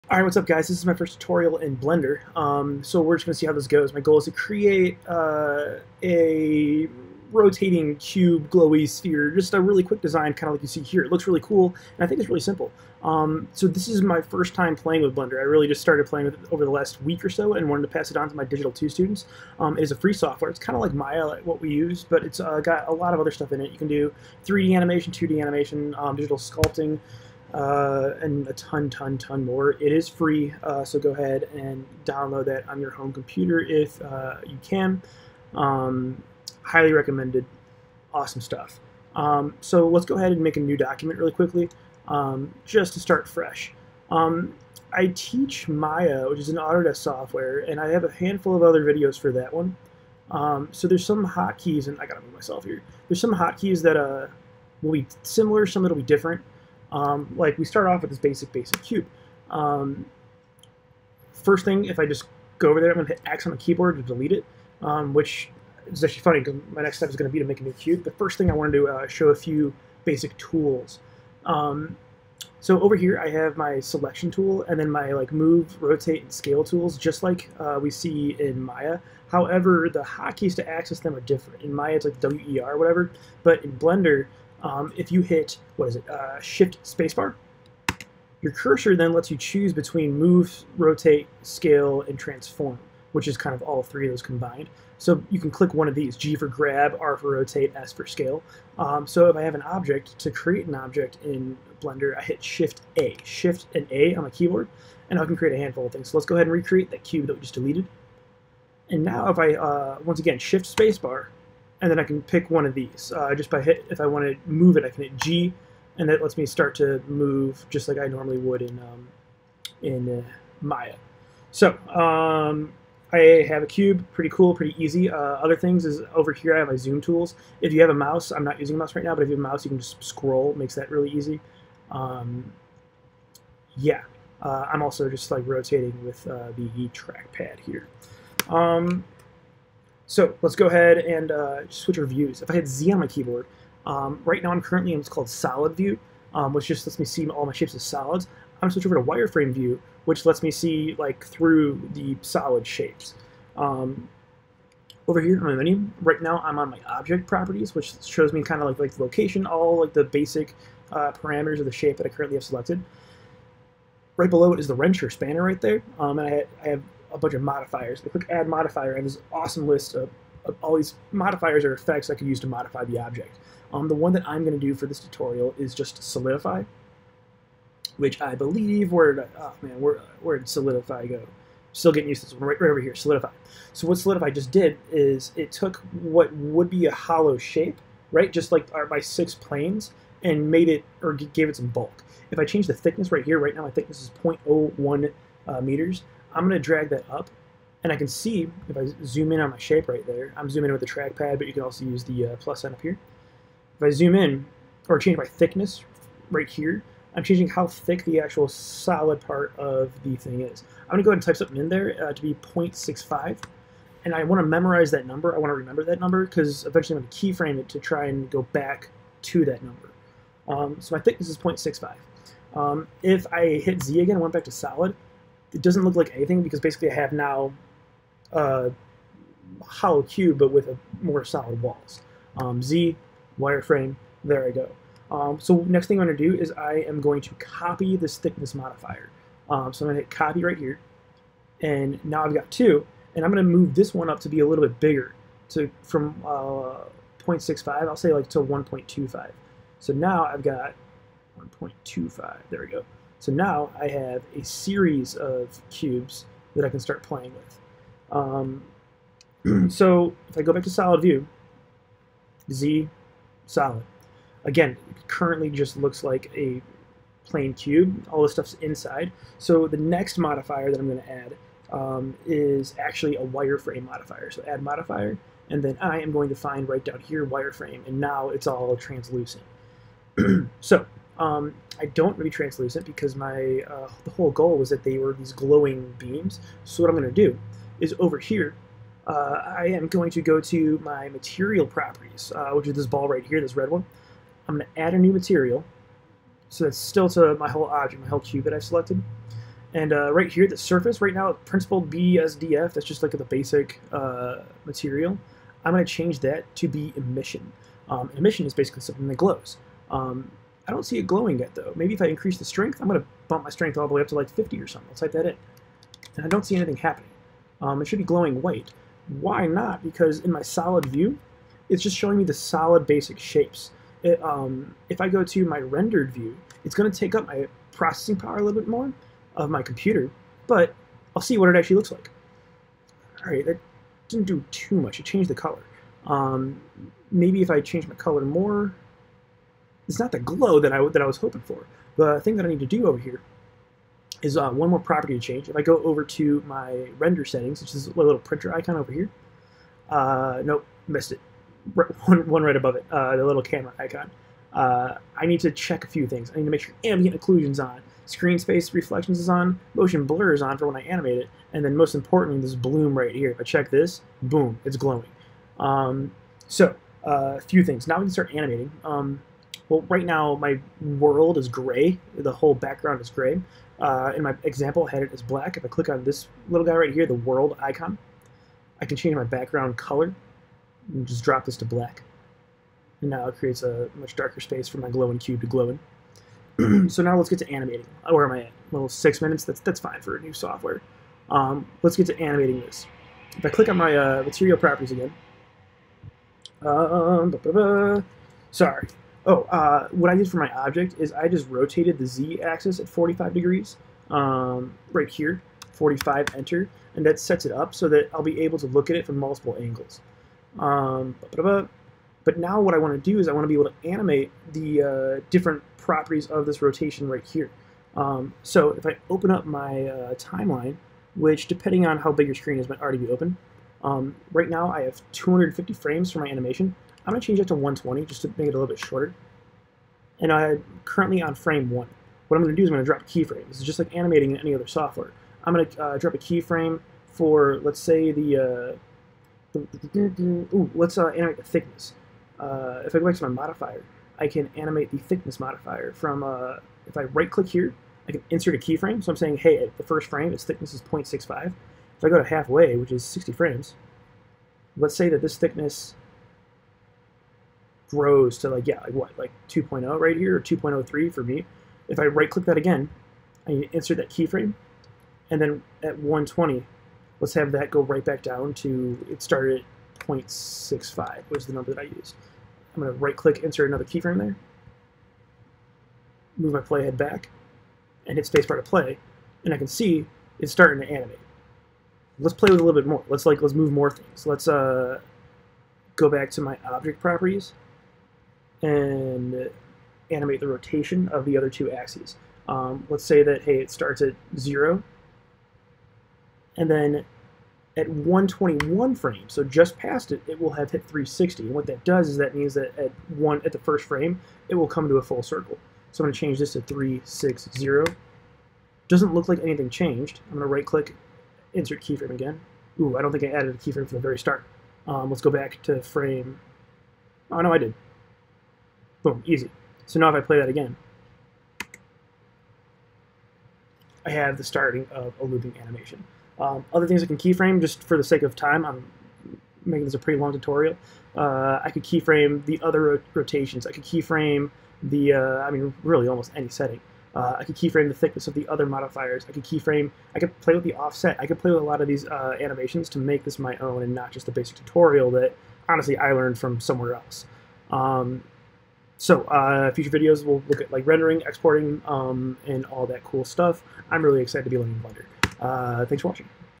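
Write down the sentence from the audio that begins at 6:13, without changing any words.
Uh, in my example, I had it as black.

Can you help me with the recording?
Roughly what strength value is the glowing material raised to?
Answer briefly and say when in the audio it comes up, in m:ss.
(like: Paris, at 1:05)
50, at 5:14.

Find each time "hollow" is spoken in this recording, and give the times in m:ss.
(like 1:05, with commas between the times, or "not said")
3:06, 3:49.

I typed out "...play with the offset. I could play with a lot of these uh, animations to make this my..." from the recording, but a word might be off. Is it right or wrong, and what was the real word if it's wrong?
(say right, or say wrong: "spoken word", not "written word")
right.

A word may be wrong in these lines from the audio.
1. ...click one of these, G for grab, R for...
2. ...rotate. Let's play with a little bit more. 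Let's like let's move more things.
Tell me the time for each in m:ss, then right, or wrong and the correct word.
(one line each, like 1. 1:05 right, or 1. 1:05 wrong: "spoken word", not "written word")
1. 1:35 right
2. 8:00 wrong: "animate", not "rotate".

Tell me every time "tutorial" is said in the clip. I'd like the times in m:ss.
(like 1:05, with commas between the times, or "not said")
0:01, 2:54, 8:50, 9:04.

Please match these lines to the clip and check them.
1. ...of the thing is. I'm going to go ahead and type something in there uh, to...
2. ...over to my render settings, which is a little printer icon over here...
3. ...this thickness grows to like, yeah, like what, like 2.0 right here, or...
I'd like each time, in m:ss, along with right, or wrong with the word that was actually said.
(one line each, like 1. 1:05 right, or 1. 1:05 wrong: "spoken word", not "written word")
1. 3:29 right
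2. 5:45 right
3. 7:35 right.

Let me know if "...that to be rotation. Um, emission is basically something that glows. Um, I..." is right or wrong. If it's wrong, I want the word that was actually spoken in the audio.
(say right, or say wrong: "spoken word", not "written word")
wrong: "emission", not "rotation".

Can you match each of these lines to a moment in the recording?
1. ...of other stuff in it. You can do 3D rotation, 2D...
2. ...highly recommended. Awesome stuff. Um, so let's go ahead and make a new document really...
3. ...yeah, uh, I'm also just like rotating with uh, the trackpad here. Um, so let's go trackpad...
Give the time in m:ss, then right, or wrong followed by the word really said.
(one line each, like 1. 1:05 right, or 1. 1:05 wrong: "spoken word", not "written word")
1. 0:23 wrong: "animation", not "rotation"
2. 0:36 right
3. 2:13 wrong: "ahead", not "trackpad".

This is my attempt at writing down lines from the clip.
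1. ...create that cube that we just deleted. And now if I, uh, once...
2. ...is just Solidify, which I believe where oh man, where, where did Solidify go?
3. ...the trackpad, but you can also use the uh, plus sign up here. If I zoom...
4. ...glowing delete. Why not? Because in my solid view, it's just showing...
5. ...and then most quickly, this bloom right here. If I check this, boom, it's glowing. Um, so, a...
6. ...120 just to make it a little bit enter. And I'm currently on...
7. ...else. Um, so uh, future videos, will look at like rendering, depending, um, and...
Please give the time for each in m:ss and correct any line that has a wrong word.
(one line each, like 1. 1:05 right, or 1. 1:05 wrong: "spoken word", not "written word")
1. 1:46 wrong: "recreate", not "create"
2. 2:55 right
3. 3:20 right
4. 5:18 wrong: "white", not "delete"
5. 6:01 wrong: "importantly", not "quickly"
6. 7:07 wrong: "shorter", not "enter"
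7. 9:06 wrong: "exporting", not "depending".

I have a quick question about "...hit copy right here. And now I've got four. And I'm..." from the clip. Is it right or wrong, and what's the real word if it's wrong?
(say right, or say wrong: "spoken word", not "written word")
wrong: "two", not "four".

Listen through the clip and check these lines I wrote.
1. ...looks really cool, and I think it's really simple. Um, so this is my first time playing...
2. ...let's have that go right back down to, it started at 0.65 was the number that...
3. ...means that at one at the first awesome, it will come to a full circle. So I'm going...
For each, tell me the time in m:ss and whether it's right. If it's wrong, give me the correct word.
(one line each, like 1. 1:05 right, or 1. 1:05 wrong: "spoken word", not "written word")
1. 0:11 right
2. 7:47 right
3. 8:22 wrong: "frame", not "awesome".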